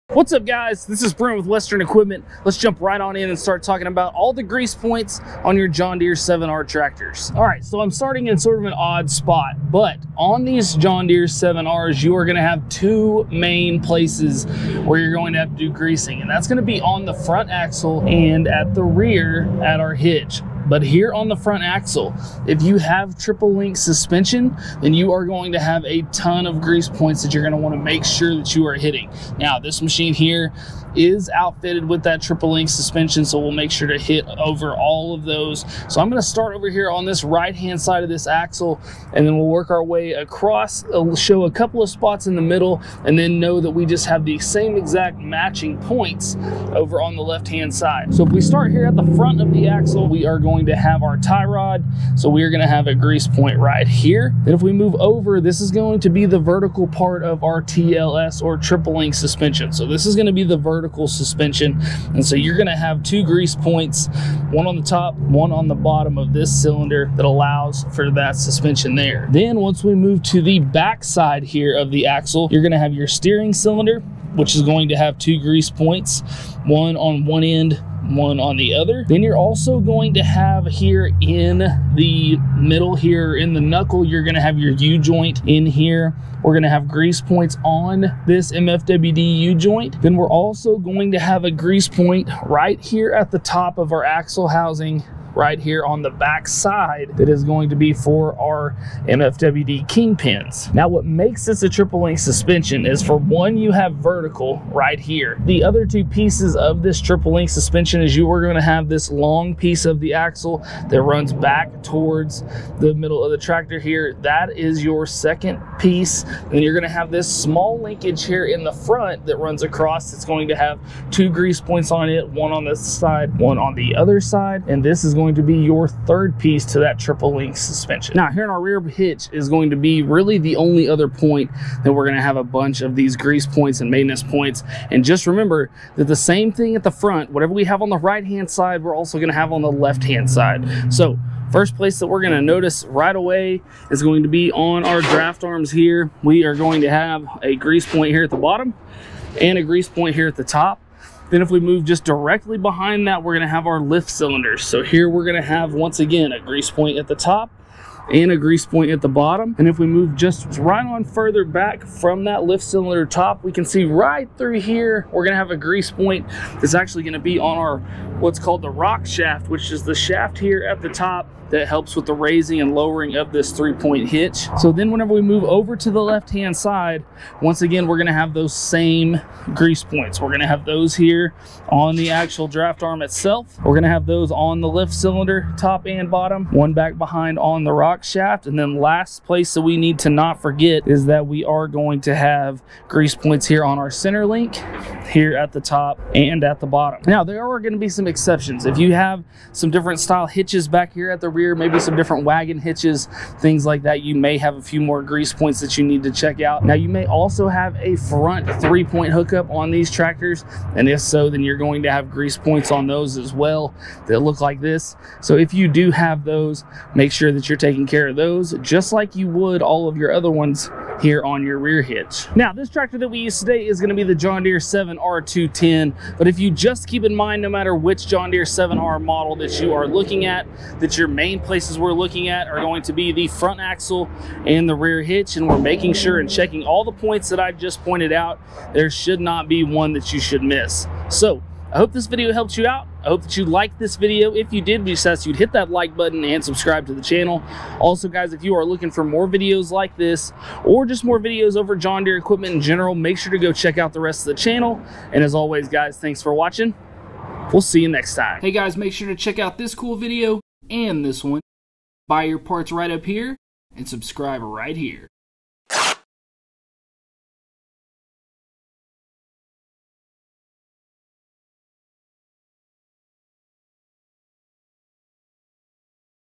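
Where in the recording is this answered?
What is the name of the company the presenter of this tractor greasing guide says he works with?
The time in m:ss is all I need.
0:01.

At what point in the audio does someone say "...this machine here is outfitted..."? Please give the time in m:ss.
0:29.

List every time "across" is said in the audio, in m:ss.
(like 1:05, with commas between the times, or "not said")
0:40, 1:59.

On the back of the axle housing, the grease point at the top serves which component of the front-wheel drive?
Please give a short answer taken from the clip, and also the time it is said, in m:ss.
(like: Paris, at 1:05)
MFWD kingpins, at 1:39.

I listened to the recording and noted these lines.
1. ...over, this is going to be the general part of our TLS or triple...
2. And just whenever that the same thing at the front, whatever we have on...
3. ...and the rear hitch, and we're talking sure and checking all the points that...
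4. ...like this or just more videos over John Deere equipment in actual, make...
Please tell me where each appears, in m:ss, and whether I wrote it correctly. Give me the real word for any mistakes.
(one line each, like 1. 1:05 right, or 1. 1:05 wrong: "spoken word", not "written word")
1. 0:54 wrong: "vertical", not "general"
2. 2:14 wrong: "remember", not "whenever"
3. 3:54 wrong: "making", not "talking"
4. 4:09 wrong: "general", not "actual".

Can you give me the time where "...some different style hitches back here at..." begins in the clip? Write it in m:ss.
3:19.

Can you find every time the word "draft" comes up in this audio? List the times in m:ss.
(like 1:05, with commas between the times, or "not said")
2:25, 3:02.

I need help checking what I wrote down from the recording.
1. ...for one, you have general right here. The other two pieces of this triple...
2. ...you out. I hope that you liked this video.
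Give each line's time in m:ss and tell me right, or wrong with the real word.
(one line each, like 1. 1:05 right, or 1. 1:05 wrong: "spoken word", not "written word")
1. 1:43 wrong: "vertical", not "general"
2. 4:02 right.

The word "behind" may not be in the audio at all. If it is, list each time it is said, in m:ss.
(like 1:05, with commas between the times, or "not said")
2:32, 3:06.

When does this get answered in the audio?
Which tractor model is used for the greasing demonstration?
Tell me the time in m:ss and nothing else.
3:44.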